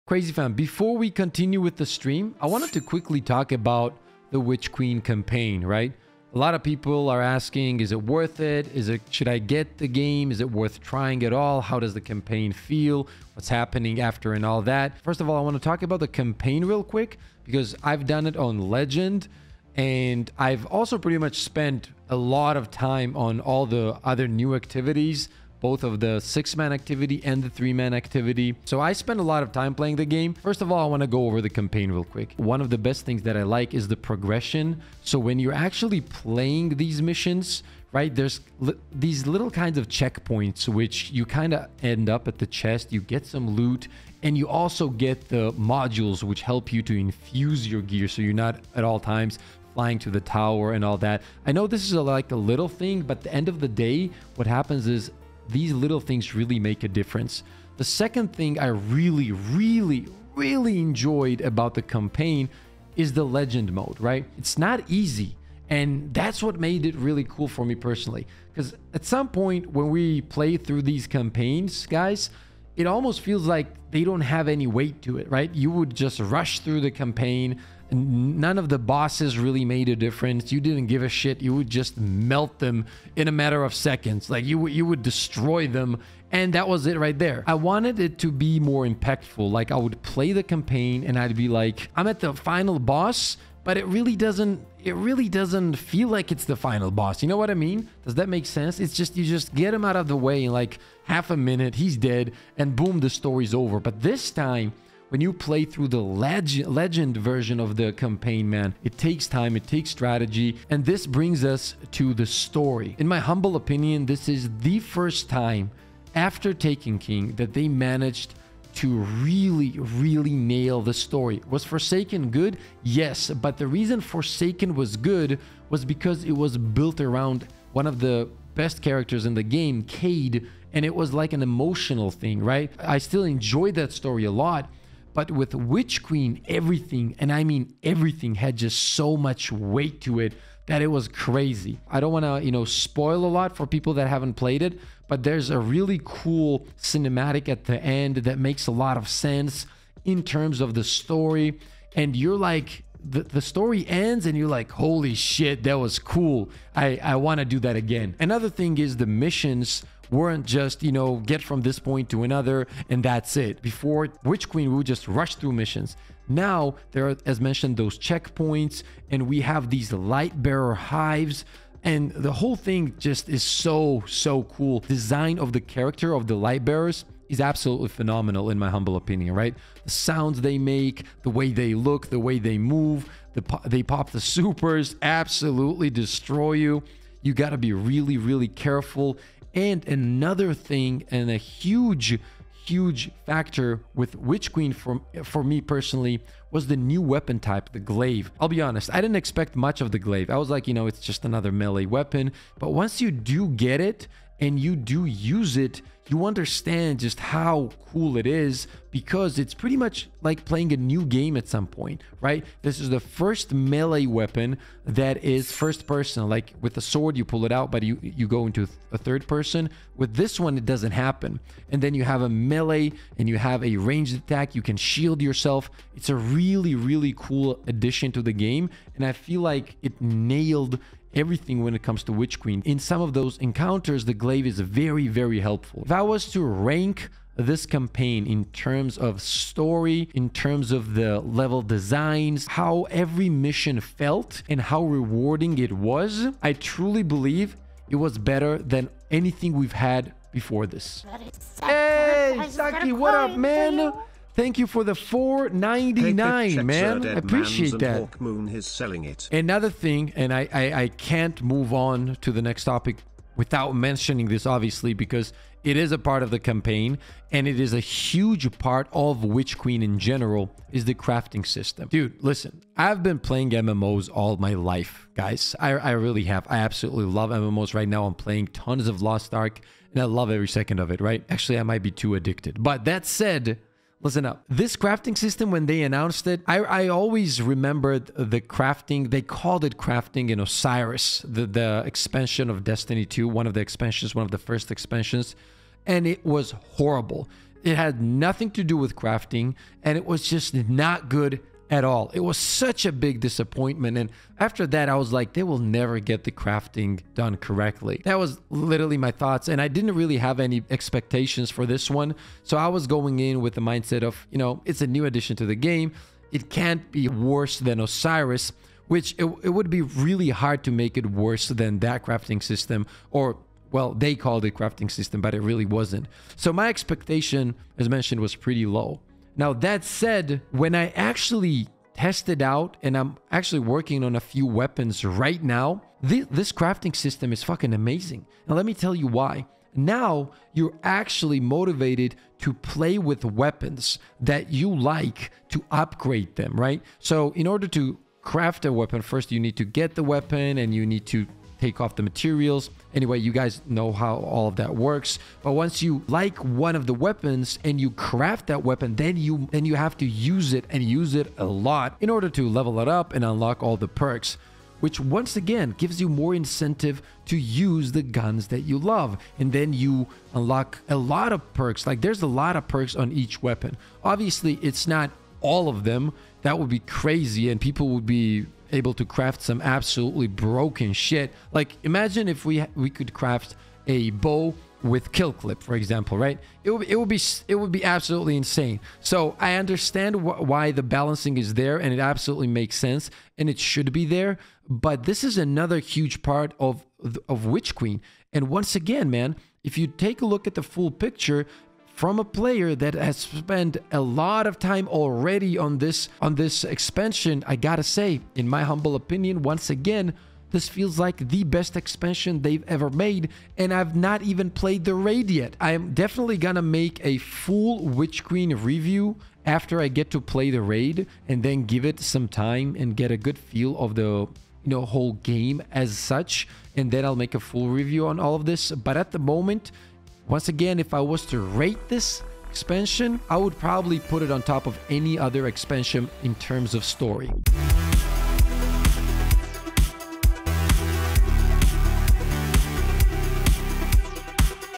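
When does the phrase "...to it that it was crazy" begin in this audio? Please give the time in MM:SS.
02:20.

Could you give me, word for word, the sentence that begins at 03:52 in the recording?
In some of those encounters, the glaive is very, very helpful.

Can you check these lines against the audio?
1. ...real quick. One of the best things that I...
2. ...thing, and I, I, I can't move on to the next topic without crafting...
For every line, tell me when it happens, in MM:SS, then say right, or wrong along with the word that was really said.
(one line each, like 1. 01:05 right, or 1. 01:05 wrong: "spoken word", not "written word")
1. 00:31 right
2. 04:19 wrong: "mentioning", not "crafting".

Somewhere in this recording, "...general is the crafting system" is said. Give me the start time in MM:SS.
04:29.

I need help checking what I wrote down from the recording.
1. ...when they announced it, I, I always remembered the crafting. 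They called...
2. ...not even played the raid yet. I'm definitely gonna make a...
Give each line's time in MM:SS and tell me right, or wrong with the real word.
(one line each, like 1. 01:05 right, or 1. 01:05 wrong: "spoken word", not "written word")
1. 04:45 right
2. 06:53 right.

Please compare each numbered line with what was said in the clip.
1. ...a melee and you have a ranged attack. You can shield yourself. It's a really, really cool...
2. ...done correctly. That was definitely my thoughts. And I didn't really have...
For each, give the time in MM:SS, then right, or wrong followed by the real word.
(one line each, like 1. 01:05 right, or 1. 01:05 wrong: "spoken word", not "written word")
1. 03:42 right
2. 05:07 wrong: "literally", not "definitely".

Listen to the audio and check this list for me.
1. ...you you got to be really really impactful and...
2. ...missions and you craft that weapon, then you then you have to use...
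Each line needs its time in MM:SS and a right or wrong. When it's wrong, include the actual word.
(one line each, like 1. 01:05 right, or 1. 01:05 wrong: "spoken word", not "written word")
1. 03:06 wrong: "careful", not "impactful"
2. 05:56 wrong: "weapons", not "missions".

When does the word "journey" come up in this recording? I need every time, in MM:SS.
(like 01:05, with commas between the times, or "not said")
not said.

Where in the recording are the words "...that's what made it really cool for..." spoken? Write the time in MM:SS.
01:06.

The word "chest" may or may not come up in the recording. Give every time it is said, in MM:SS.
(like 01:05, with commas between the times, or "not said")
00:42.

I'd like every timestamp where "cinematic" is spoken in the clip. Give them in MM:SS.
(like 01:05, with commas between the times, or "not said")
02:26.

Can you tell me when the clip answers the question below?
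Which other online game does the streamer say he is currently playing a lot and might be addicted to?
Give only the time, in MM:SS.
04:39.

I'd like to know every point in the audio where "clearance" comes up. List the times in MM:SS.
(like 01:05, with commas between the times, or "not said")
not said.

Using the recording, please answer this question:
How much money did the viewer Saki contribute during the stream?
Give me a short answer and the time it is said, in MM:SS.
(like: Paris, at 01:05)
4.99, at 04:14.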